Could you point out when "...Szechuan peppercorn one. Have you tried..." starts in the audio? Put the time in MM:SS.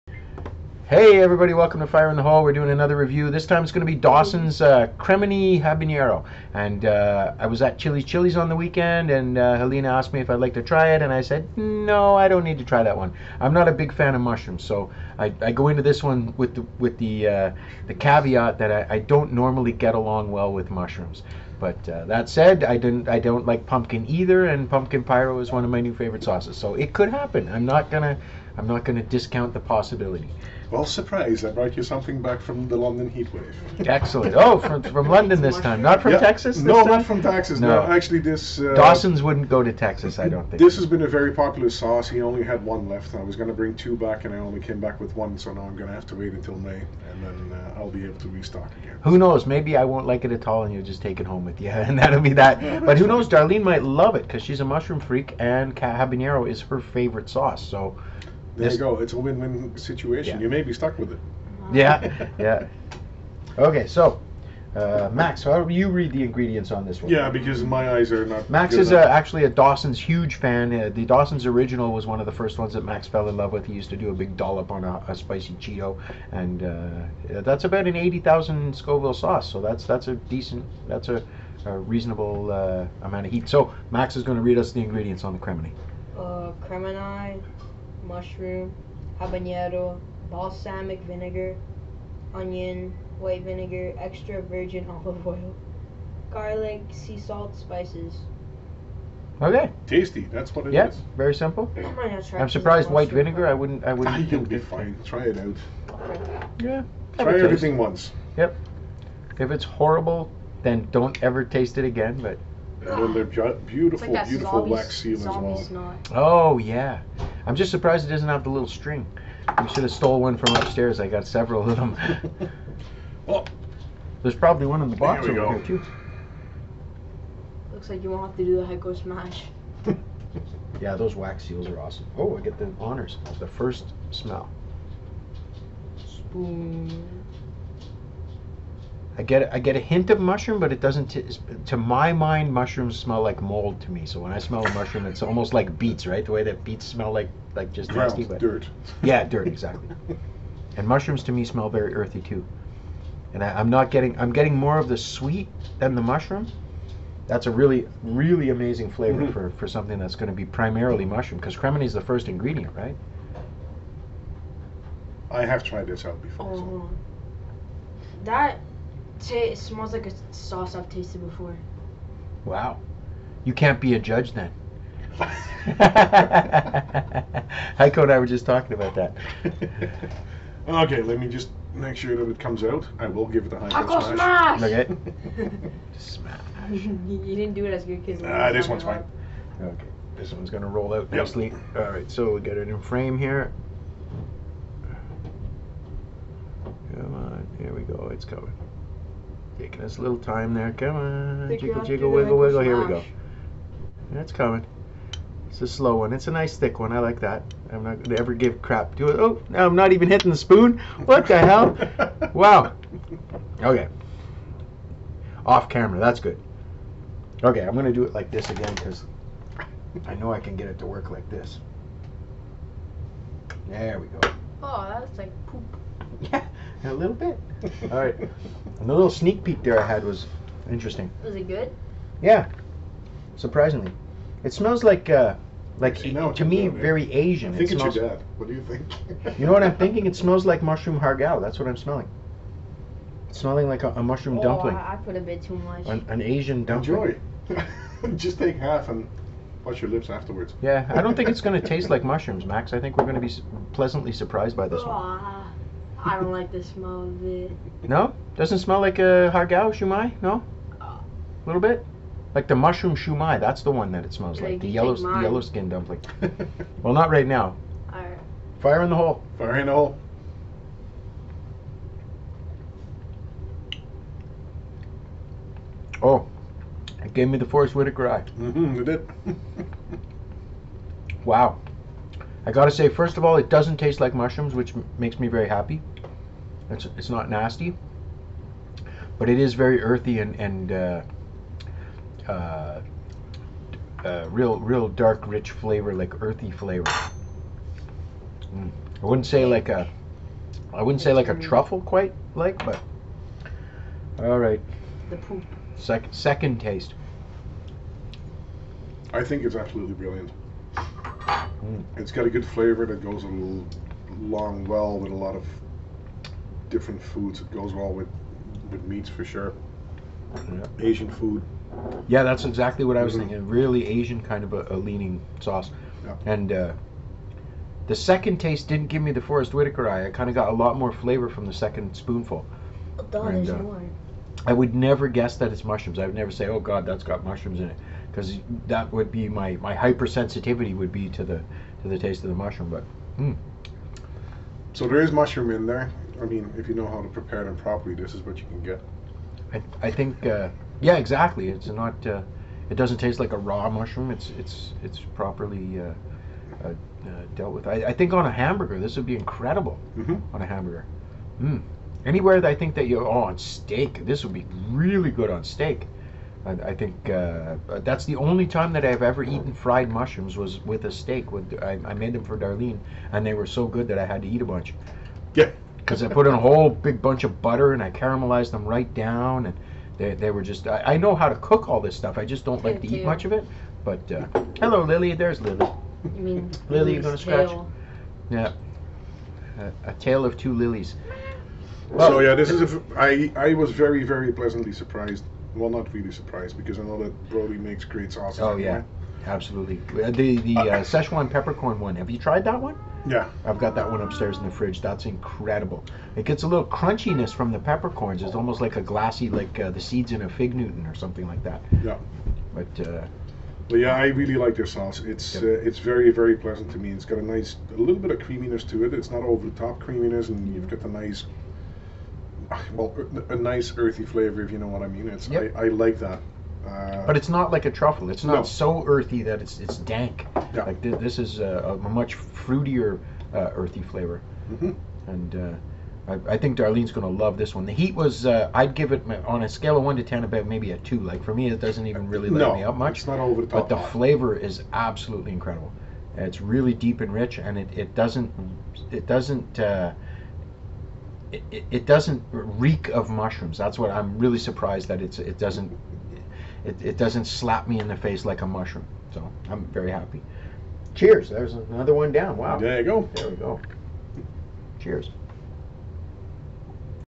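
06:40.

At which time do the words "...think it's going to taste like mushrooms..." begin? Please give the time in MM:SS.
04:11.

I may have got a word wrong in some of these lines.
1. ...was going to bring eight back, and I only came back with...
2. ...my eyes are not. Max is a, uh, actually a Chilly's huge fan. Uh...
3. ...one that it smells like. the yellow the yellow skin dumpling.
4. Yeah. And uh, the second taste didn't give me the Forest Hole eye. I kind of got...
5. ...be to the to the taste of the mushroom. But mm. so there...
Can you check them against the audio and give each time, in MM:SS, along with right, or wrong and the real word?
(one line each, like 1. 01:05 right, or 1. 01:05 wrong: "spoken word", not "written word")
1. 00:43 wrong: "two", not "eight"
2. 01:07 wrong: "Dawson", not "Chilly"
3. 04:23 right
4. 05:26 wrong: "Whitaker", not "Hole"
5. 05:40 right.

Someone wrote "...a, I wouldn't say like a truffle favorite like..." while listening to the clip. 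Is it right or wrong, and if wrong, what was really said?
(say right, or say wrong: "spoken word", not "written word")
wrong: "quite", not "favorite".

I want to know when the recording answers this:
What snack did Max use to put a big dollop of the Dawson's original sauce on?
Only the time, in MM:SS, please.
01:15.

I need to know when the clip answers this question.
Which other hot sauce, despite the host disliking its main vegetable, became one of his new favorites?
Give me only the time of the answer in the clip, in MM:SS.
00:24.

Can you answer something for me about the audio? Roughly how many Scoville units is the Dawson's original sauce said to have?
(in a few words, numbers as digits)
80,000.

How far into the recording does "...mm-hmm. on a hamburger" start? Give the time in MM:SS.
05:59.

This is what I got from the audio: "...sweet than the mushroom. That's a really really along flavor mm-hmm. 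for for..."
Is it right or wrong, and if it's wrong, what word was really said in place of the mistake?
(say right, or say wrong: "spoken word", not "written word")
wrong: "amazing", not "along".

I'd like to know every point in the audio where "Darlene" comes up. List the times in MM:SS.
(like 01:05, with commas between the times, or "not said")
00:53, 06:12, 07:16.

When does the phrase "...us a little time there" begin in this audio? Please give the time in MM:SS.
03:19.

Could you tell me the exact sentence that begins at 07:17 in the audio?
The heat was uh, I'd give it uh, on a scale of one to ten about maybe a two.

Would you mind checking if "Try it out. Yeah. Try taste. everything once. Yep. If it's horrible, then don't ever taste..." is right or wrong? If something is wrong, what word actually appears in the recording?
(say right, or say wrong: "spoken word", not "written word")
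right.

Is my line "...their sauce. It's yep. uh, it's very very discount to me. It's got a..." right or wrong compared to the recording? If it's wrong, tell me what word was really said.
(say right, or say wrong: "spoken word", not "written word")
wrong: "pleasant", not "discount".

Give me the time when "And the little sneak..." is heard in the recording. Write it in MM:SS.
03:48.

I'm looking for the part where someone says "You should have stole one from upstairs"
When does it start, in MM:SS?
01:59.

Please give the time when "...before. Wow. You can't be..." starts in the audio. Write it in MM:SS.
02:51.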